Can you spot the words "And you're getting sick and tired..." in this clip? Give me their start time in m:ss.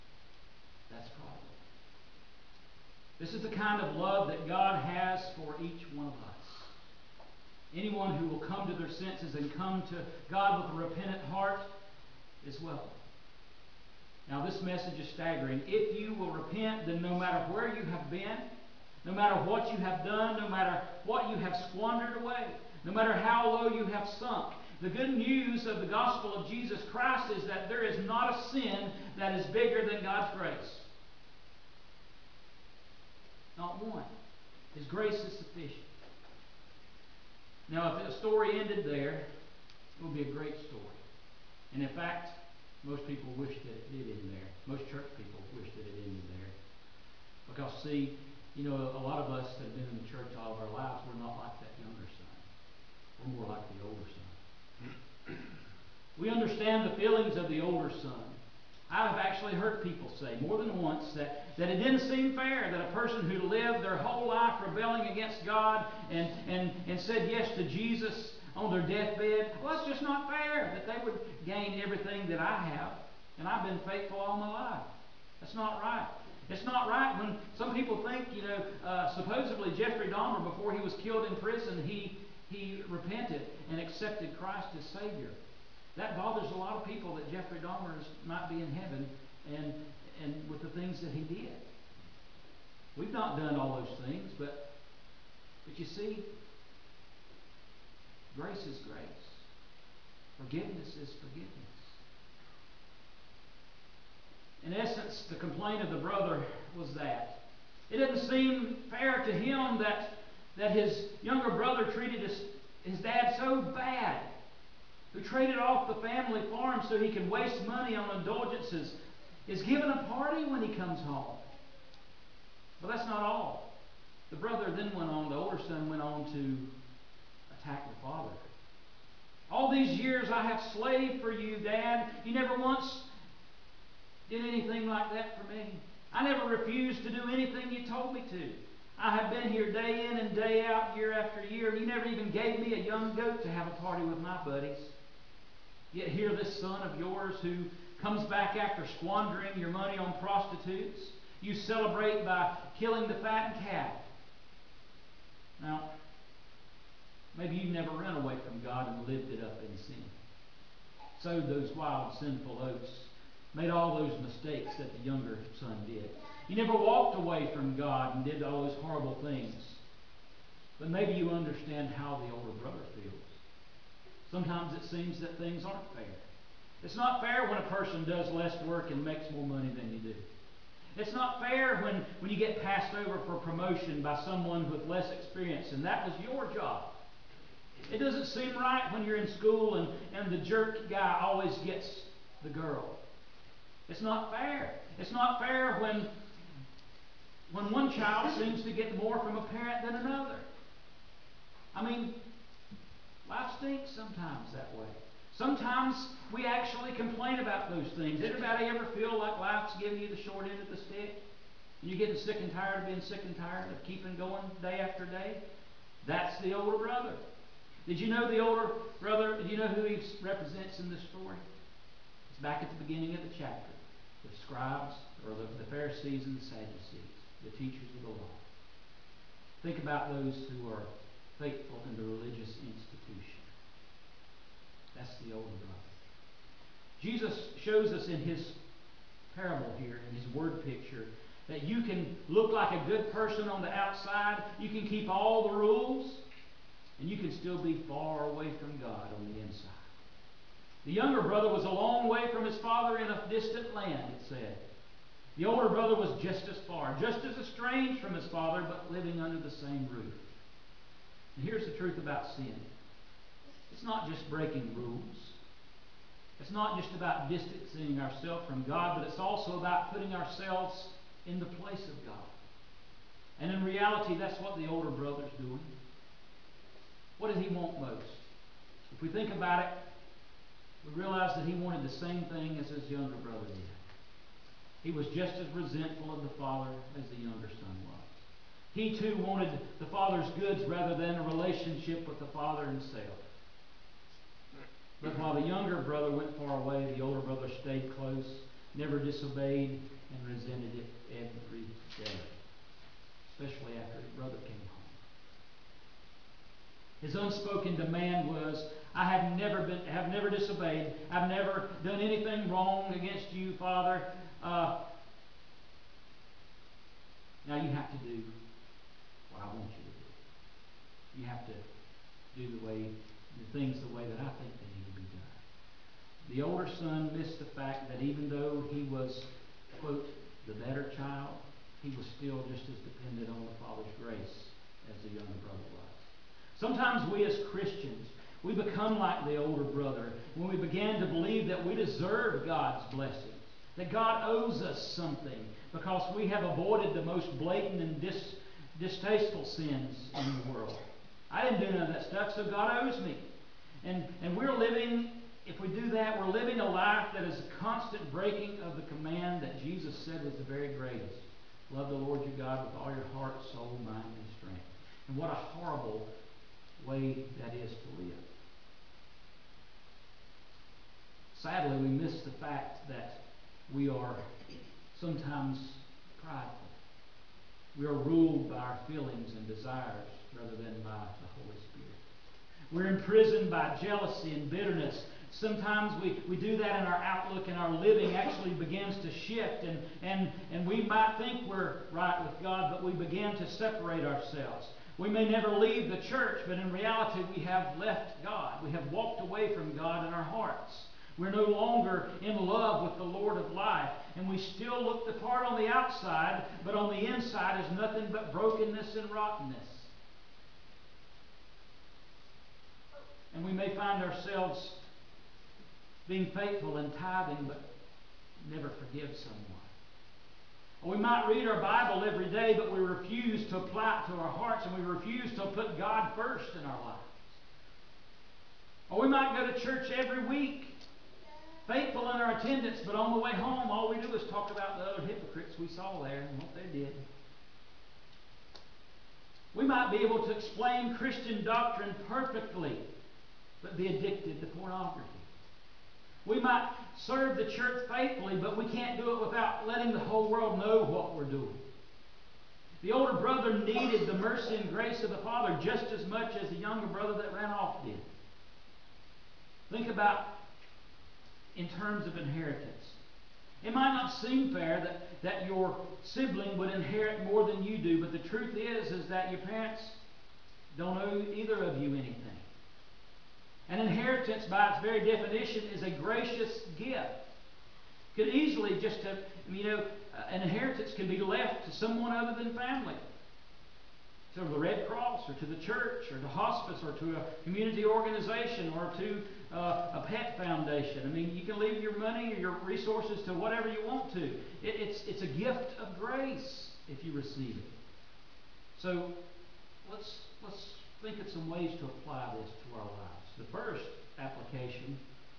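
3:31.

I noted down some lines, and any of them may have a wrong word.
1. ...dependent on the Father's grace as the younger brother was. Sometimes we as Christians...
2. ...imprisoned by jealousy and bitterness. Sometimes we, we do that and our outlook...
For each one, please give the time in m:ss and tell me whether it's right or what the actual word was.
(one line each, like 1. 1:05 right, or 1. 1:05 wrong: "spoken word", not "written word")
1. 5:32 right
2. 6:22 right.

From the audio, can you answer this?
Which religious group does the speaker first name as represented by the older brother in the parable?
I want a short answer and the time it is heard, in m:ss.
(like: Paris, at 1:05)
The scribes, at 3:44.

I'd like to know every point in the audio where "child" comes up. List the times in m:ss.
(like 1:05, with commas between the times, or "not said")
3:17, 5:30.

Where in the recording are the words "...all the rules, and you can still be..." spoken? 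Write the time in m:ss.
4:05.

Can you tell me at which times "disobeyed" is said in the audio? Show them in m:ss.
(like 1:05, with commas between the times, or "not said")
4:58, 5:10.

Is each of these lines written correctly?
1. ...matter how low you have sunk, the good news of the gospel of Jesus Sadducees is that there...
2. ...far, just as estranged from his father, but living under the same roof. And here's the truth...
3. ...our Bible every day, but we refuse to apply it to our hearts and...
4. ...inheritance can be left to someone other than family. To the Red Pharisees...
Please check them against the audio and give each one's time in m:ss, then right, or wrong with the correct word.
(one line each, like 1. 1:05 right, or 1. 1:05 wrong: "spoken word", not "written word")
1. 0:22 wrong: "Christ", not "Sadducees"
2. 4:16 right
3. 7:01 right
4. 8:00 wrong: "Cross", not "Pharisees".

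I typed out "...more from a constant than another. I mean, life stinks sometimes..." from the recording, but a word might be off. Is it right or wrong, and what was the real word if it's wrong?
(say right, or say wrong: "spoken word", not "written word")
wrong: "parent", not "constant".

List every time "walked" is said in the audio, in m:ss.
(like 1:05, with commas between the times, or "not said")
2:46, 6:38.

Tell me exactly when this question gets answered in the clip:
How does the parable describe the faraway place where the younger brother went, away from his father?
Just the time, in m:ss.
4:13.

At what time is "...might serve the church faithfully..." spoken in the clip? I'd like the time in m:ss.
7:26.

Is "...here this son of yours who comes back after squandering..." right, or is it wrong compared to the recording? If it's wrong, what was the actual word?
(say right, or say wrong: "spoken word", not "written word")
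right.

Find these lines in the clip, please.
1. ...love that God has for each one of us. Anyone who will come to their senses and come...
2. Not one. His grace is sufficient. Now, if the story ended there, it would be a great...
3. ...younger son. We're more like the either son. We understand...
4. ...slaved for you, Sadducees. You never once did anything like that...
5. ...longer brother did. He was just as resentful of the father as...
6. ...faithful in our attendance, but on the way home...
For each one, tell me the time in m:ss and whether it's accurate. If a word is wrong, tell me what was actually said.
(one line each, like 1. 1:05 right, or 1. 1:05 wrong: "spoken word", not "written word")
1. 0:03 right
2. 0:33 right
3. 0:51 wrong: "older", not "either"
4. 2:10 wrong: "Dad", not "Sadducees"
5. 4:42 wrong: "younger", not "longer"
6. 7:11 right.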